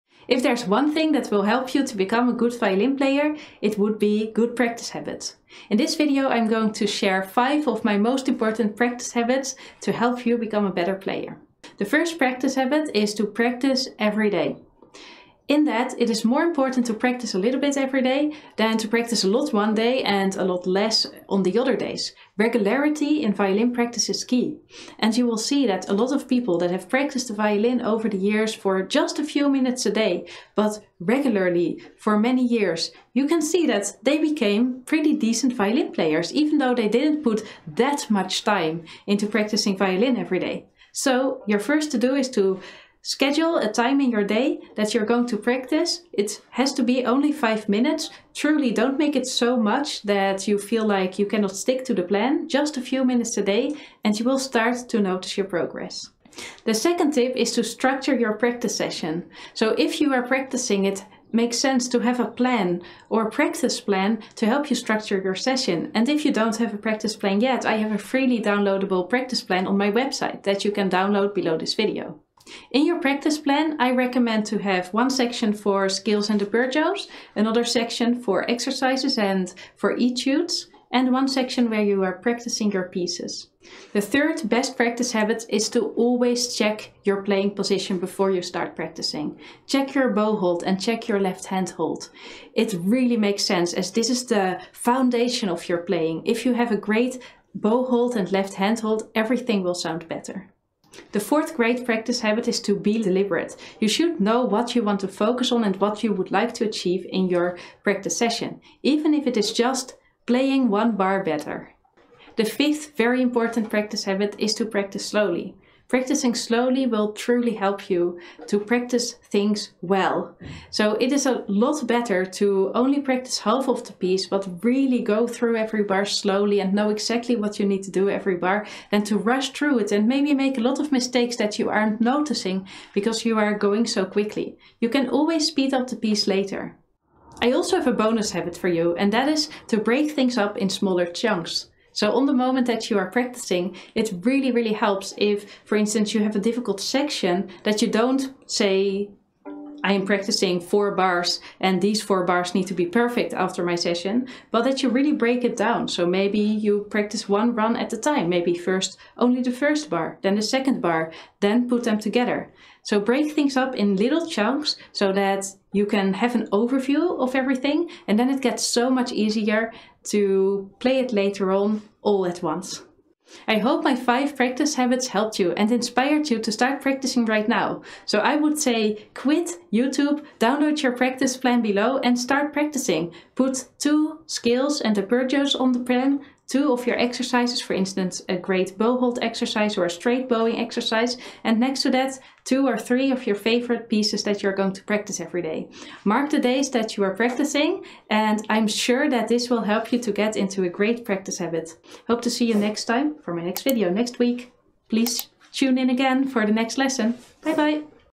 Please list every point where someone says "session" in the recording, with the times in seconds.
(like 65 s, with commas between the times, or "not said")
58 s, 65 s, 108 s, 153 s.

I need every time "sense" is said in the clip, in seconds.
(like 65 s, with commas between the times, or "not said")
61 s, 93 s.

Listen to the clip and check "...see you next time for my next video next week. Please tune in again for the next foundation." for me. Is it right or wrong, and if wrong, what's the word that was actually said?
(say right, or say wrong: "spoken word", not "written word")
wrong: "lesson", not "foundation".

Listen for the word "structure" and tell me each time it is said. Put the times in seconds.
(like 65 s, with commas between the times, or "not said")
57 s, 64 s.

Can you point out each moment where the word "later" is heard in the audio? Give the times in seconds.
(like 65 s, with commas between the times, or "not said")
136 s, 171 s.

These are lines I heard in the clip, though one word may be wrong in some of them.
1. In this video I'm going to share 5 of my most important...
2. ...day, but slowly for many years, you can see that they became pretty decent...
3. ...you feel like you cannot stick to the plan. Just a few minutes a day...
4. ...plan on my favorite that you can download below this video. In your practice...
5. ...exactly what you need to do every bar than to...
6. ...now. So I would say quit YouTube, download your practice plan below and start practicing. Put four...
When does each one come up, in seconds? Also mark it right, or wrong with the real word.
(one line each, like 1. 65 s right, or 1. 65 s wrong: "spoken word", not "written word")
1. 5 s right
2. 29 s wrong: "regularly", not "slowly"
3. 50 s right
4. 69 s wrong: "website", not "favorite"
5. 126 s right
6. 177 s wrong: "two", not "four".